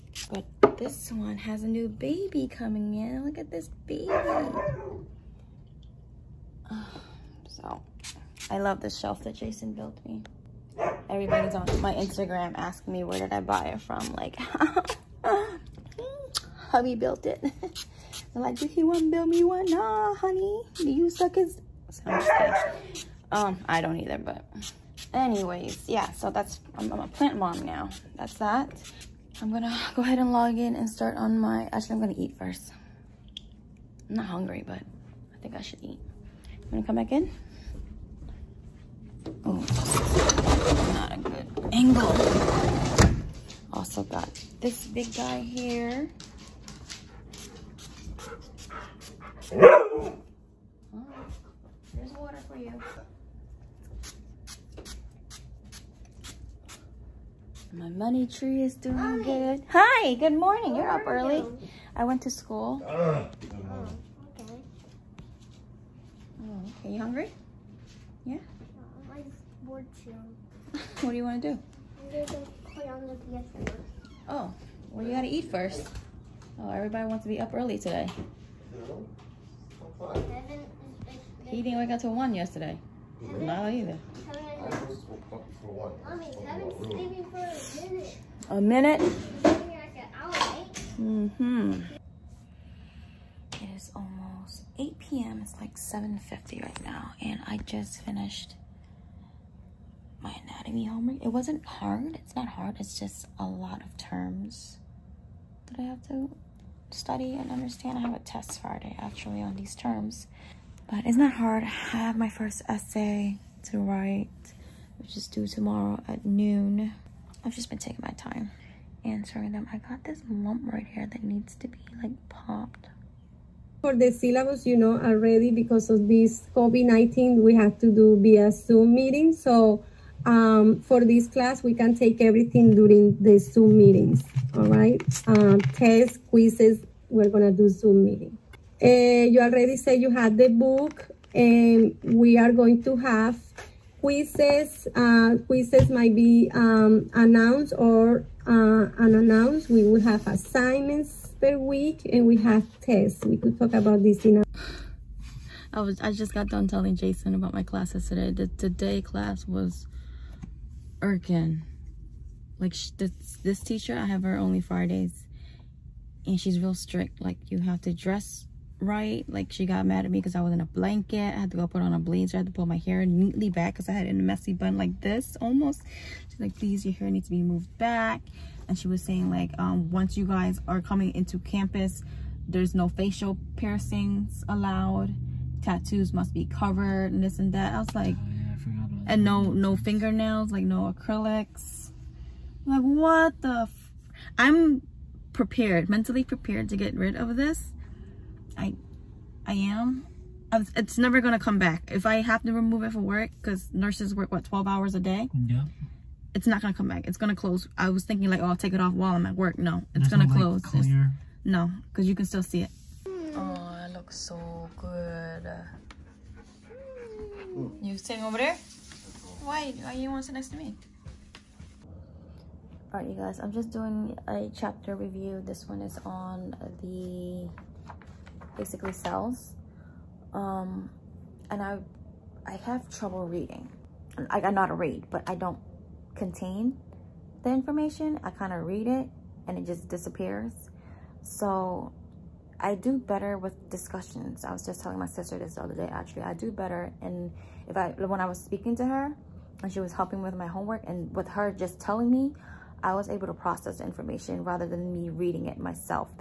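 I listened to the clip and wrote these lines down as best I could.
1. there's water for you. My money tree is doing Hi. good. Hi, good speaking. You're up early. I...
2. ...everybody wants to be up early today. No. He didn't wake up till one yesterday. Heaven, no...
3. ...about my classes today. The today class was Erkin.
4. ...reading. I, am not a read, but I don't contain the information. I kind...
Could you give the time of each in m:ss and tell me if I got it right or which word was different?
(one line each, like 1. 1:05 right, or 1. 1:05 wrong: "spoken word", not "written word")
1. 0:49 wrong: "morning", not "speaking"
2. 1:16 right
3. 2:37 right
4. 3:53 right.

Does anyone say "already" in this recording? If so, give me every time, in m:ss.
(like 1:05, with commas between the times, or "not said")
2:05, 2:19.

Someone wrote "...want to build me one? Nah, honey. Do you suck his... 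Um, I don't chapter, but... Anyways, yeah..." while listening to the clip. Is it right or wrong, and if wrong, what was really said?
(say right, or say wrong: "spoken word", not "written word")
wrong: "either", not "chapter".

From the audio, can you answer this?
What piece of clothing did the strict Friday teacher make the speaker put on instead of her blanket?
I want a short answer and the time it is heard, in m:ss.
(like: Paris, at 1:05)
A blazer, at 2:51.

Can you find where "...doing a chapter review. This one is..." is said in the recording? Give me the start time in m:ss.
3:43.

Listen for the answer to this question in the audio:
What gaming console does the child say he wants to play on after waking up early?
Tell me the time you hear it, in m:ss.
1:13.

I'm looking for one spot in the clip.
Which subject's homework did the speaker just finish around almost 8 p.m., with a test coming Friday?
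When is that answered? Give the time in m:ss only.
1:40.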